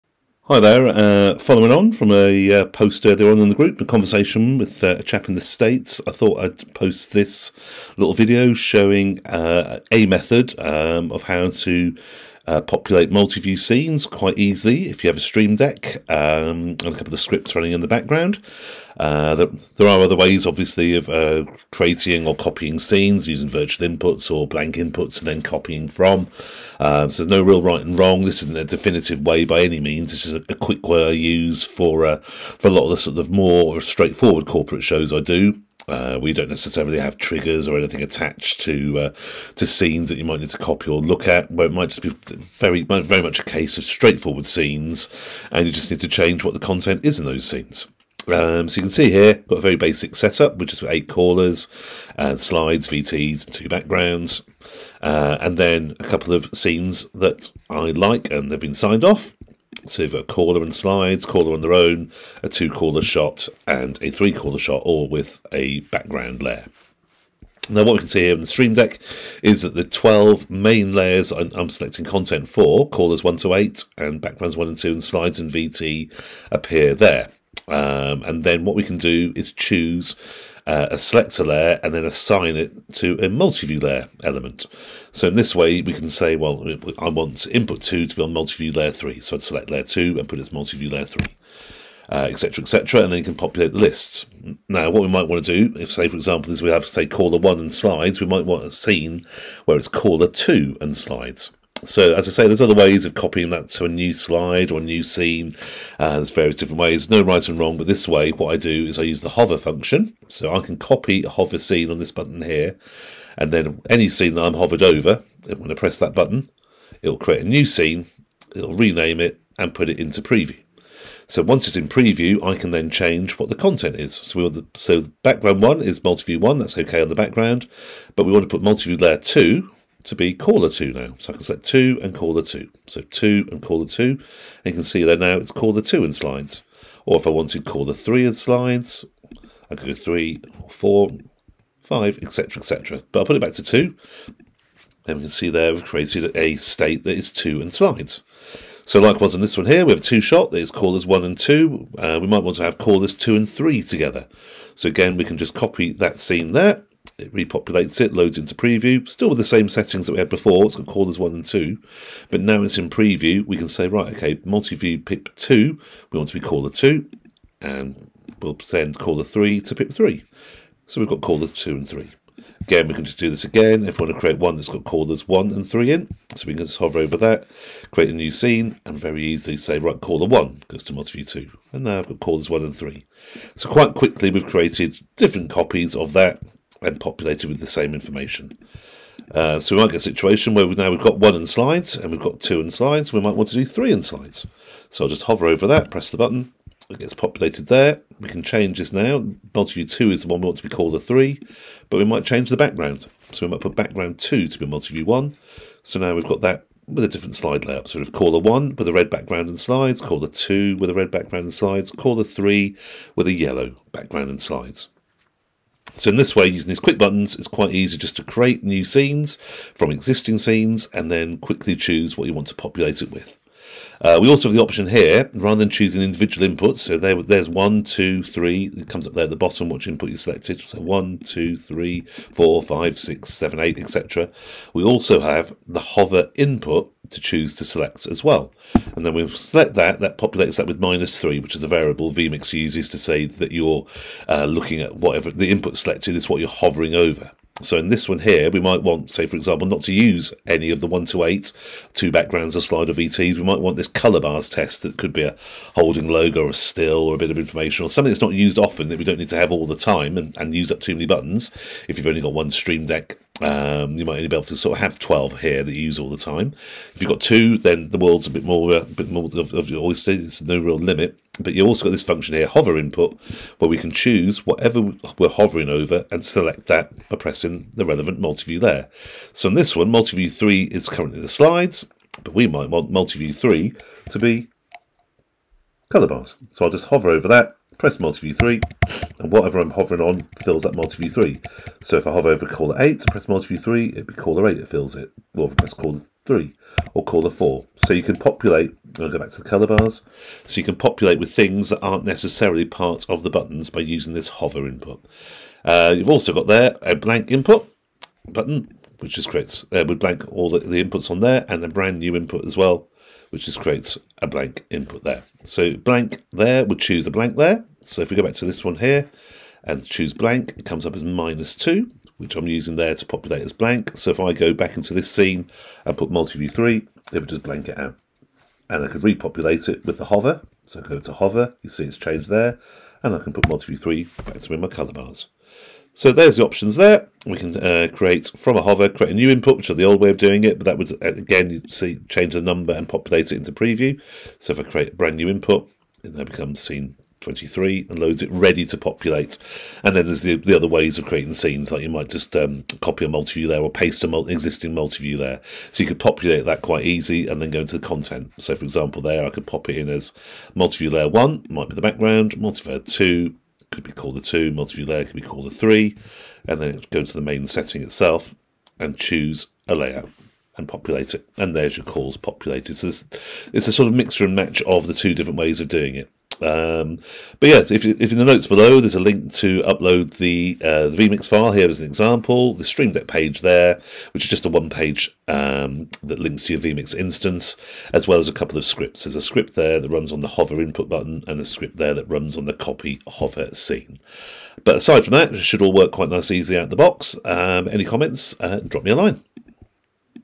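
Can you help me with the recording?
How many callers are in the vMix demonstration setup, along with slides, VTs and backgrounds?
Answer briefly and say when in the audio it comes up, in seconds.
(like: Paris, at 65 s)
8, at 50 s.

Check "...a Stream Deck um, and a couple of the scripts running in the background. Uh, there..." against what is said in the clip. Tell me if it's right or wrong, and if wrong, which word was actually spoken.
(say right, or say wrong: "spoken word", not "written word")
right.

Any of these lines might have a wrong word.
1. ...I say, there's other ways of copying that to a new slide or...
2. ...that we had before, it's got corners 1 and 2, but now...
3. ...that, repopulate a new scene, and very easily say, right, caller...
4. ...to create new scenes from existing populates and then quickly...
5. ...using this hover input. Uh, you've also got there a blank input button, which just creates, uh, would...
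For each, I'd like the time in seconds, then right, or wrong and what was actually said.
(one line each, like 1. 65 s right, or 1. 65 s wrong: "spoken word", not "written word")
1. 102 s right
2. 160 s right
3. 177 s wrong: "create", not "repopulate"
4. 218 s wrong: "scenes", not "populates"
5. 303 s right.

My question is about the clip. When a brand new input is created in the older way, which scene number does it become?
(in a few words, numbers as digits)
23.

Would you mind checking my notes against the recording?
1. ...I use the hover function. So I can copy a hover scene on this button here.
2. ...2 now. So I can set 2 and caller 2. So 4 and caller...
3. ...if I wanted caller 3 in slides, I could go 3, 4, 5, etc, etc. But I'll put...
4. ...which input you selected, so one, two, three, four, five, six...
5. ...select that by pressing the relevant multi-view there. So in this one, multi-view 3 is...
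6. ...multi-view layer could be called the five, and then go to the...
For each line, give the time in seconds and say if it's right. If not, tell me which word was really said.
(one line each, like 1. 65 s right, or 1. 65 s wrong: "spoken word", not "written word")
1. 108 s right
2. 130 s wrong: "2", not "4"
3. 137 s right
4. 229 s right
5. 276 s right
6. 364 s wrong: "three", not "five".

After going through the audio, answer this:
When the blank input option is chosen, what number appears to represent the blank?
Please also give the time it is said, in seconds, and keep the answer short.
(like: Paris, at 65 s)
-2, at 321 s.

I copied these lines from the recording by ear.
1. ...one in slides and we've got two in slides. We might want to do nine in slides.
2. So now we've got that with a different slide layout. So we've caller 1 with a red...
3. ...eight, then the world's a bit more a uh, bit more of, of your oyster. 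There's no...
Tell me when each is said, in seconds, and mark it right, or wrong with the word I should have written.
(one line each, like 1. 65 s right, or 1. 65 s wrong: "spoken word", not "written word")
1. 191 s wrong: "three", not "nine"
2. 205 s right
3. 267 s wrong: "two", not "eight".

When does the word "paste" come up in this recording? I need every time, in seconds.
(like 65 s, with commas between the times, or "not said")
353 s.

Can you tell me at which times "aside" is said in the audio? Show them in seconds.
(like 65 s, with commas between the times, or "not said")
394 s.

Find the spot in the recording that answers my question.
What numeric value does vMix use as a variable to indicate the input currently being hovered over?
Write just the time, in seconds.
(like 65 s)
240 s.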